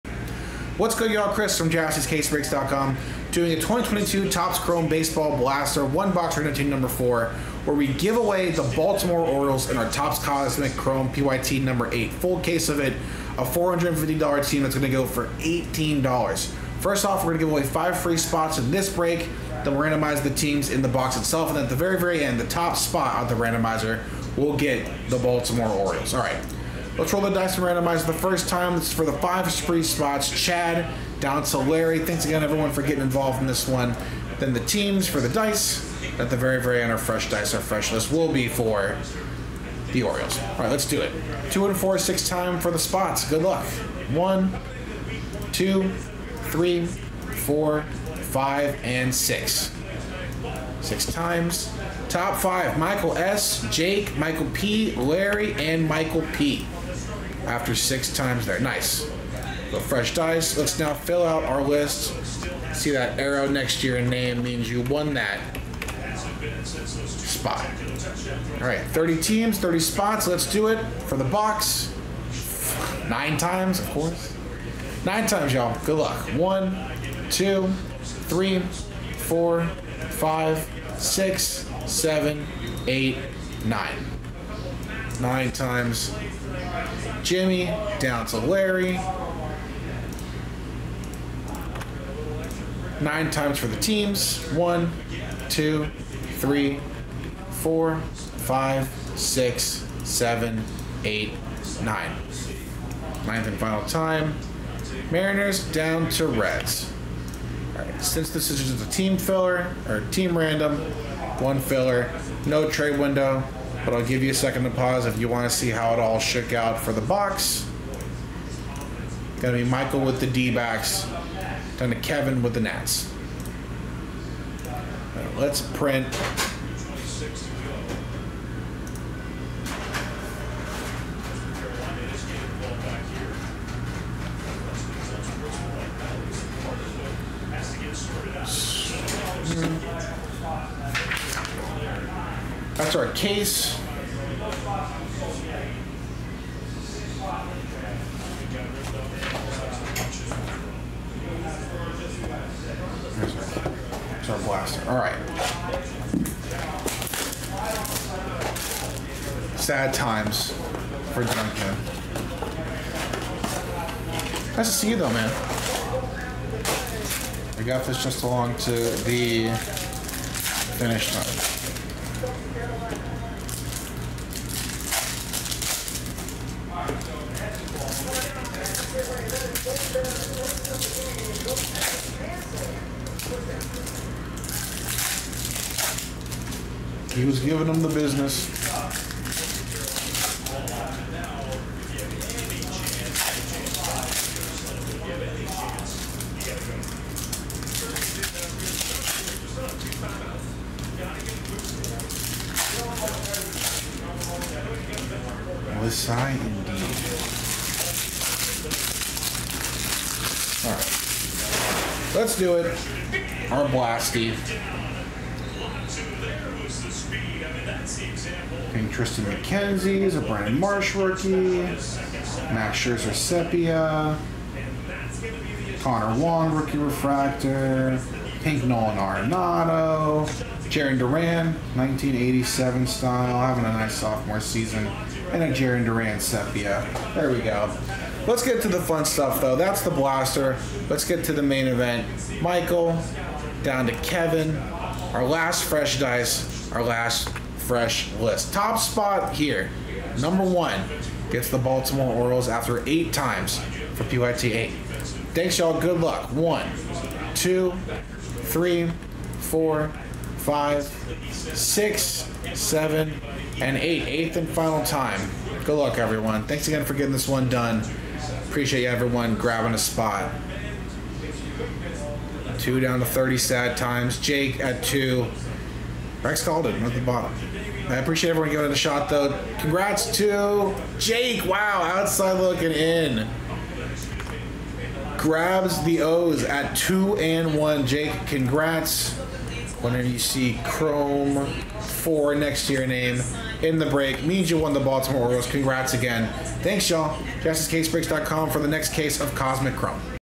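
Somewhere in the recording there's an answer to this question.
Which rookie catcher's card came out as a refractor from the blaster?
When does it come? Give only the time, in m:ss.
3:45.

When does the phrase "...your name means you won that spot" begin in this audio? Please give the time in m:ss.
1:03.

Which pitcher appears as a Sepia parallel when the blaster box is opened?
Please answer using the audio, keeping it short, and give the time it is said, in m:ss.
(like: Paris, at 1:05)
Max Scherzer, at 3:41.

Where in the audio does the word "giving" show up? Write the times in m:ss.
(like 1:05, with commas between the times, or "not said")
3:07, 4:38.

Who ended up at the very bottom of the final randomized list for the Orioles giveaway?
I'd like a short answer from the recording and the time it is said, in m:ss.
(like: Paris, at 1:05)
Rex Calden, at 4:36.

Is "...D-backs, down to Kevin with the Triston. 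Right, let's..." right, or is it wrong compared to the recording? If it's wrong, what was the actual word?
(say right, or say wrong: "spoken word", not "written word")
wrong: "Nats", not "Triston".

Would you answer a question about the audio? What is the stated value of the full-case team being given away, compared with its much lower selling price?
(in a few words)
$450.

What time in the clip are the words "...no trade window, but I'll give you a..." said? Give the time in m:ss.
1:52.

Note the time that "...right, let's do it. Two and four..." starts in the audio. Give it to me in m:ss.
0:40.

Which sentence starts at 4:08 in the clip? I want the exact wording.
Top spot here, number one, gets the Baltimore Orioles after eight times for PYT 8.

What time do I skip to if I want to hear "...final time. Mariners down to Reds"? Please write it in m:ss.
1:43.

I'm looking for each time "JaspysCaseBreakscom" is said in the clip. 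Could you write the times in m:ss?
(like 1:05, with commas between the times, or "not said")
0:01, 4:57.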